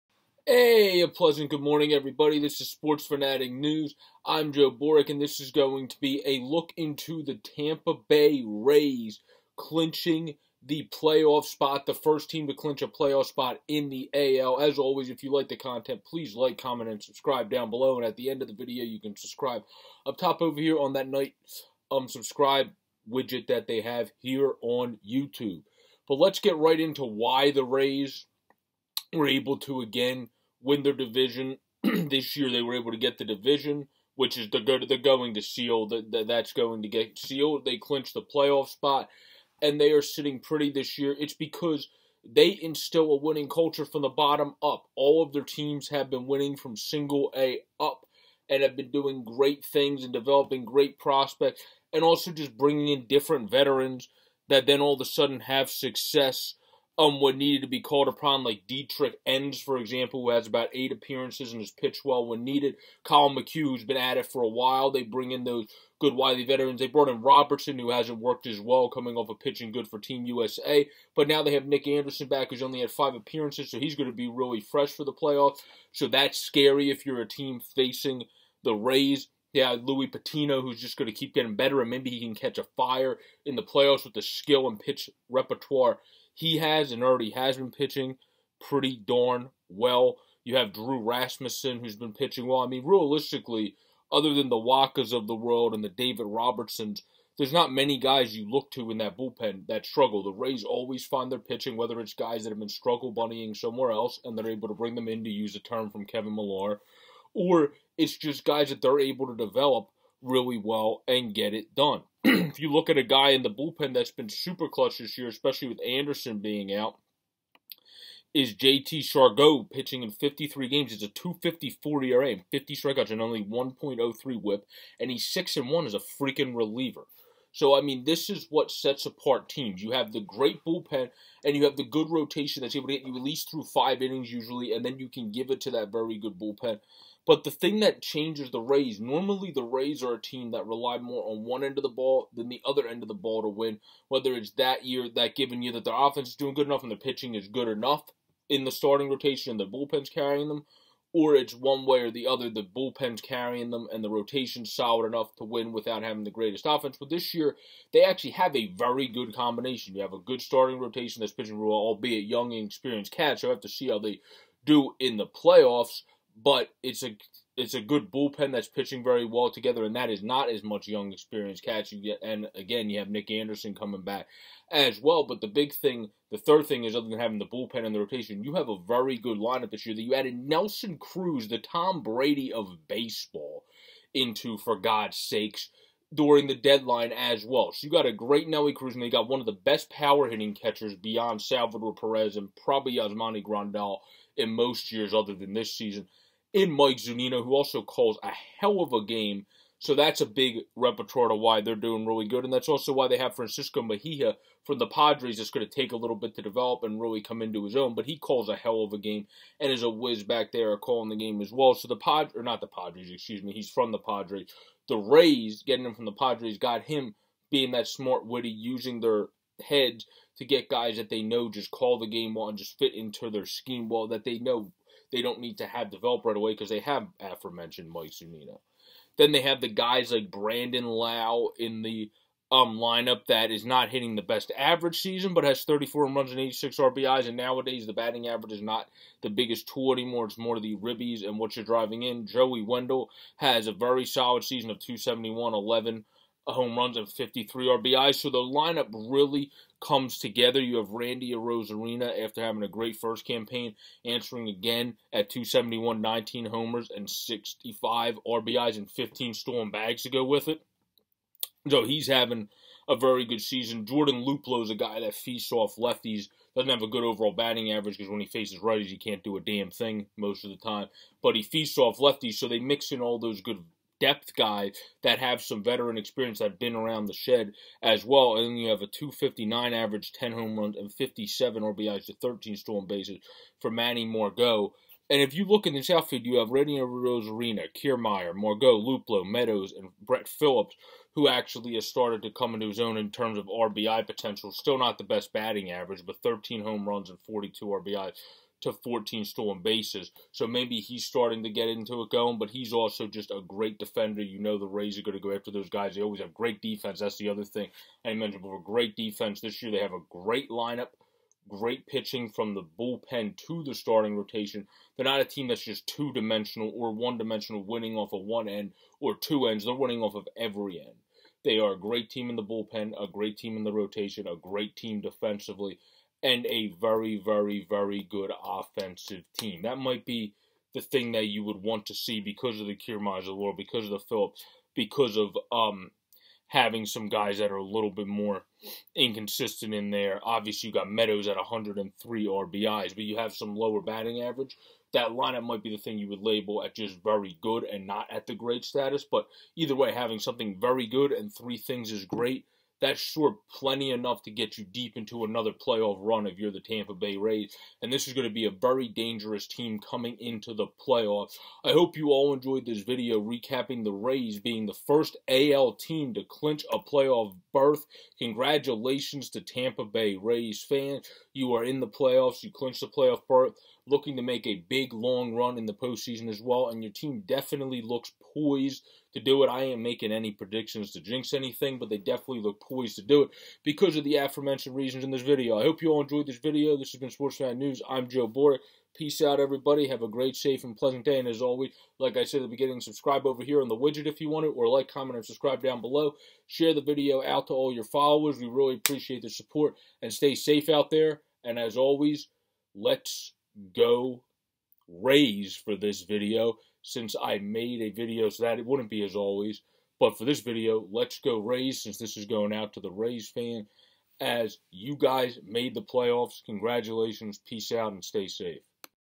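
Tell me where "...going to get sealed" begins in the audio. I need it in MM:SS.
00:36.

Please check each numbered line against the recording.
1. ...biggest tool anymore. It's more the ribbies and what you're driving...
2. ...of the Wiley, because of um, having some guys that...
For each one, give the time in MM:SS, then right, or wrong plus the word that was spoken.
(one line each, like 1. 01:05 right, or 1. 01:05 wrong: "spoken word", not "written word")
1. 03:59 right
2. 05:33 wrong: "Phillips", not "Wiley".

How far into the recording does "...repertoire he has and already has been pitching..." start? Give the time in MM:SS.
01:25.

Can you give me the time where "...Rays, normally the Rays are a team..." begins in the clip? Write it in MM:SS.
02:18.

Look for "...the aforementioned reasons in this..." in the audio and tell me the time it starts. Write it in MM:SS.
06:24.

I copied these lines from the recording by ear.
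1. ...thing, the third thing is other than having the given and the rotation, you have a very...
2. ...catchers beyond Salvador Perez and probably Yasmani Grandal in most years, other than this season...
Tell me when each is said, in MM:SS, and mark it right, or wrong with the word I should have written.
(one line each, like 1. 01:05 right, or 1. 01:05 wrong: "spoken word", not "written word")
1. 02:55 wrong: "bullpen", not "given"
2. 03:10 right.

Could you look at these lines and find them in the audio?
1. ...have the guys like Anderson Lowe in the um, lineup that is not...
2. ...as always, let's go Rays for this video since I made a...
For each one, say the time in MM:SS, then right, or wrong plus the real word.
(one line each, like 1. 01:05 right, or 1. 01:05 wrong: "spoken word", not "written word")
1. 03:49 wrong: "Brandon", not "Anderson"
2. 06:41 right.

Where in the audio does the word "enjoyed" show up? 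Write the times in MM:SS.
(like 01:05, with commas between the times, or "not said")
06:02, 06:26.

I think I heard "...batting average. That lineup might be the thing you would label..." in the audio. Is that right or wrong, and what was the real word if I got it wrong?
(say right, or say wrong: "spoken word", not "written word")
right.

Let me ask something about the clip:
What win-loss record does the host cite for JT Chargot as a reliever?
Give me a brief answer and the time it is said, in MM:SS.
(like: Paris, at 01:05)
6 and 1, at 02:05.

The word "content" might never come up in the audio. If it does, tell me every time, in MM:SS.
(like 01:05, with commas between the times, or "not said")
00:15.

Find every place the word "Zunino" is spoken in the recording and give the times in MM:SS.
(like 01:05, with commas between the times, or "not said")
03:16, 03:48.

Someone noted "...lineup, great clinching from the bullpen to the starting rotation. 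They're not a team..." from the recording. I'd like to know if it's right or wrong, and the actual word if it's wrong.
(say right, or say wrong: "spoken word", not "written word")
wrong: "pitching", not "clinching".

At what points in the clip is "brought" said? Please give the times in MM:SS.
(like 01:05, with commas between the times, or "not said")
01:06.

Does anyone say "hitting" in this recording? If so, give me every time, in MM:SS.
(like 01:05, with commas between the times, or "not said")
03:10, 03:53.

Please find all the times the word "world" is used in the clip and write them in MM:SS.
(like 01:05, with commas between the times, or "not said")
01:35, 05:33.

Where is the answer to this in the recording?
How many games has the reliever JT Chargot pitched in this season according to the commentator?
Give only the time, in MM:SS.
02:00.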